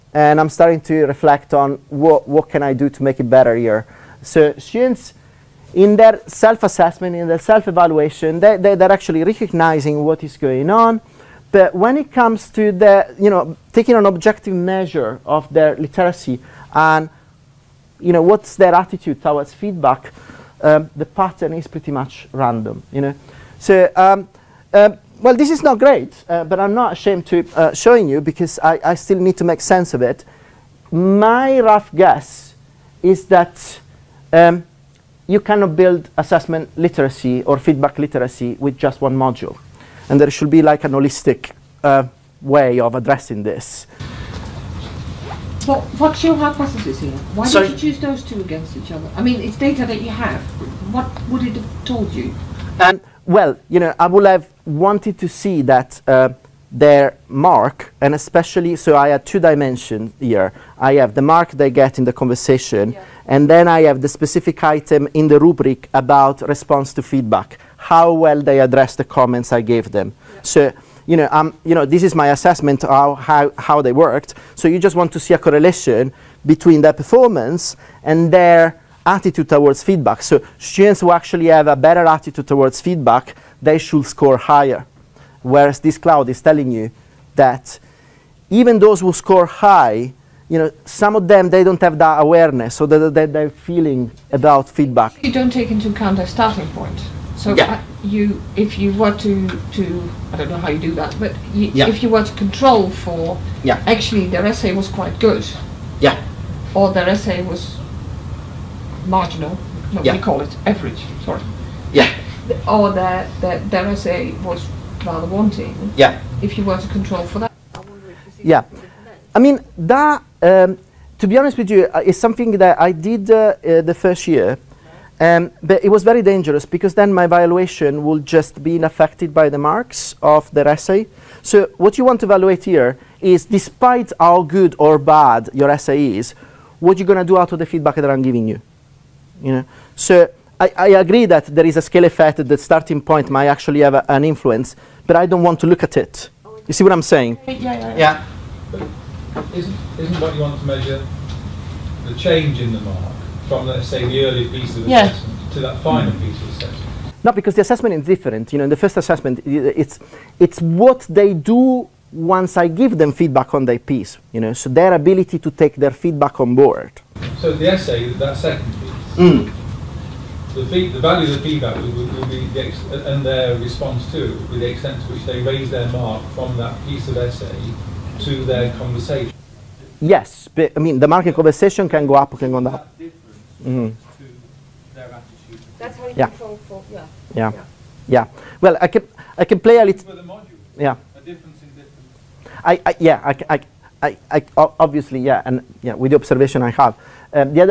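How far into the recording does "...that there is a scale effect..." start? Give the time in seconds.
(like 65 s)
141 s.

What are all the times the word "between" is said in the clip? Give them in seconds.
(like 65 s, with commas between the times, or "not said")
76 s.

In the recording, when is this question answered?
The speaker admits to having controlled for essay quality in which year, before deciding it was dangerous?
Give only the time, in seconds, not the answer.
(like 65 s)
123 s.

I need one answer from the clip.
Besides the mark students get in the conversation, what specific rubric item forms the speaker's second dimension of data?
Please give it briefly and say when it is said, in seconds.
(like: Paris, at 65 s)
response to feedback, at 66 s.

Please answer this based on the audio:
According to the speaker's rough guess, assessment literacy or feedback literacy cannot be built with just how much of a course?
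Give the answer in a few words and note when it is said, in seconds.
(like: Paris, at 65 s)
one module, at 39 s.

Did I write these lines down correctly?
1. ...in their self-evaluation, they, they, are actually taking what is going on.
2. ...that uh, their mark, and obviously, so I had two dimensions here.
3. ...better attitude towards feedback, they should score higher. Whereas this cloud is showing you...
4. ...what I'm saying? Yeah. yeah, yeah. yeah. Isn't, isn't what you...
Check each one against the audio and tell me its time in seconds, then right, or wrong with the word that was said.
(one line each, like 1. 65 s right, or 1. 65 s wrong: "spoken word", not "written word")
1. 7 s wrong: "recognizing", not "taking"
2. 55 s wrong: "especially", not "obviously"
3. 81 s wrong: "telling", not "showing"
4. 146 s right.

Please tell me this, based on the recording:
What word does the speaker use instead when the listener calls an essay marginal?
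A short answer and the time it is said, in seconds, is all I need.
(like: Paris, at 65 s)
average, at 110 s.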